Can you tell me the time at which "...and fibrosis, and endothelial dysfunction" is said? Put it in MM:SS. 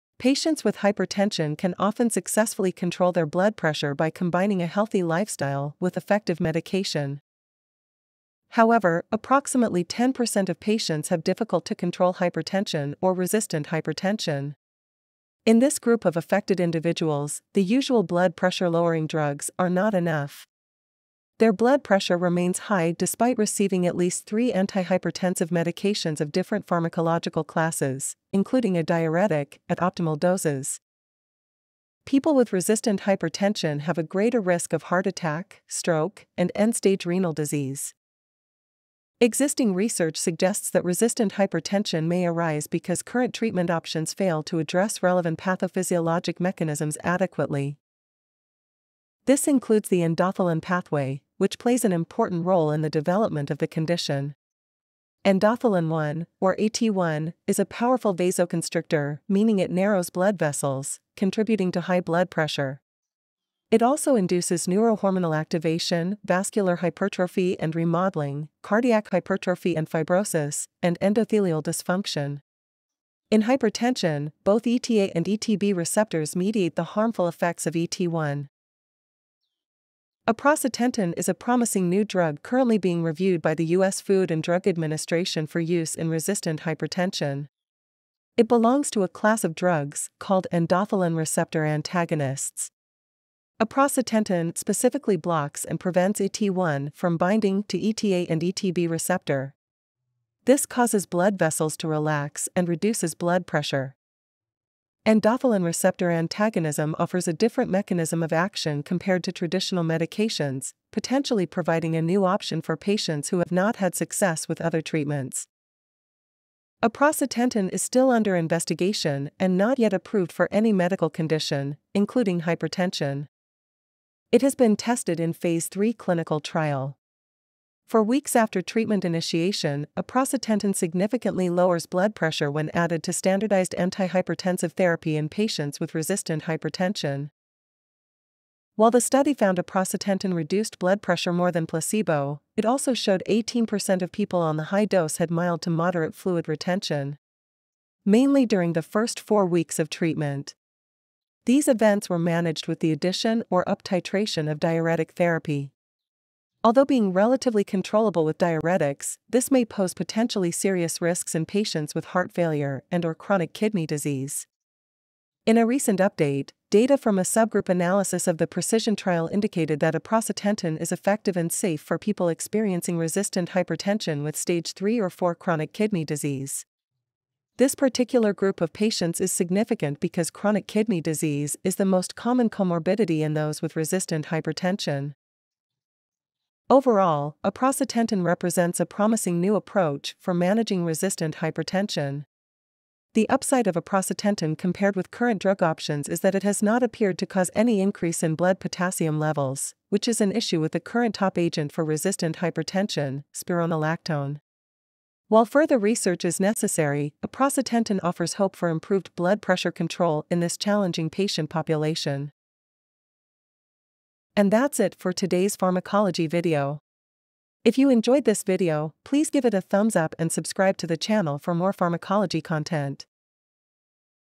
01:09.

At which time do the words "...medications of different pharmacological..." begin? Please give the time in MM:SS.
00:25.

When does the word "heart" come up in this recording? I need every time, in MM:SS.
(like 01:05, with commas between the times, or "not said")
00:34, 02:42.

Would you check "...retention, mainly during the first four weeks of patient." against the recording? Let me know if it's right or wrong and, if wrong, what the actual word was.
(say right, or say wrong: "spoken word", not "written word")
wrong: "treatment", not "patient".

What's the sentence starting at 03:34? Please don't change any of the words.
And that's it for today's pharmacology video.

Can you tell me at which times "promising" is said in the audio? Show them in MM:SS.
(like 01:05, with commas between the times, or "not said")
01:21, 03:08.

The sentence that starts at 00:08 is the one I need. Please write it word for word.
However, approximately 10% of patients have difficult to control hypertension or resistant hypertension.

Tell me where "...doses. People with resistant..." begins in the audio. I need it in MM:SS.
00:30.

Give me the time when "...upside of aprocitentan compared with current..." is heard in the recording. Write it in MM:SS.
03:13.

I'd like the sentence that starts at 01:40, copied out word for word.
This causes blood vessels to relax and reduces blood pressure.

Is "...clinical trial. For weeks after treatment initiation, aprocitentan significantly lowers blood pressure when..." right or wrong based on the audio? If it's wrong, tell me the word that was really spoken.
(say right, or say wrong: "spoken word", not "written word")
right.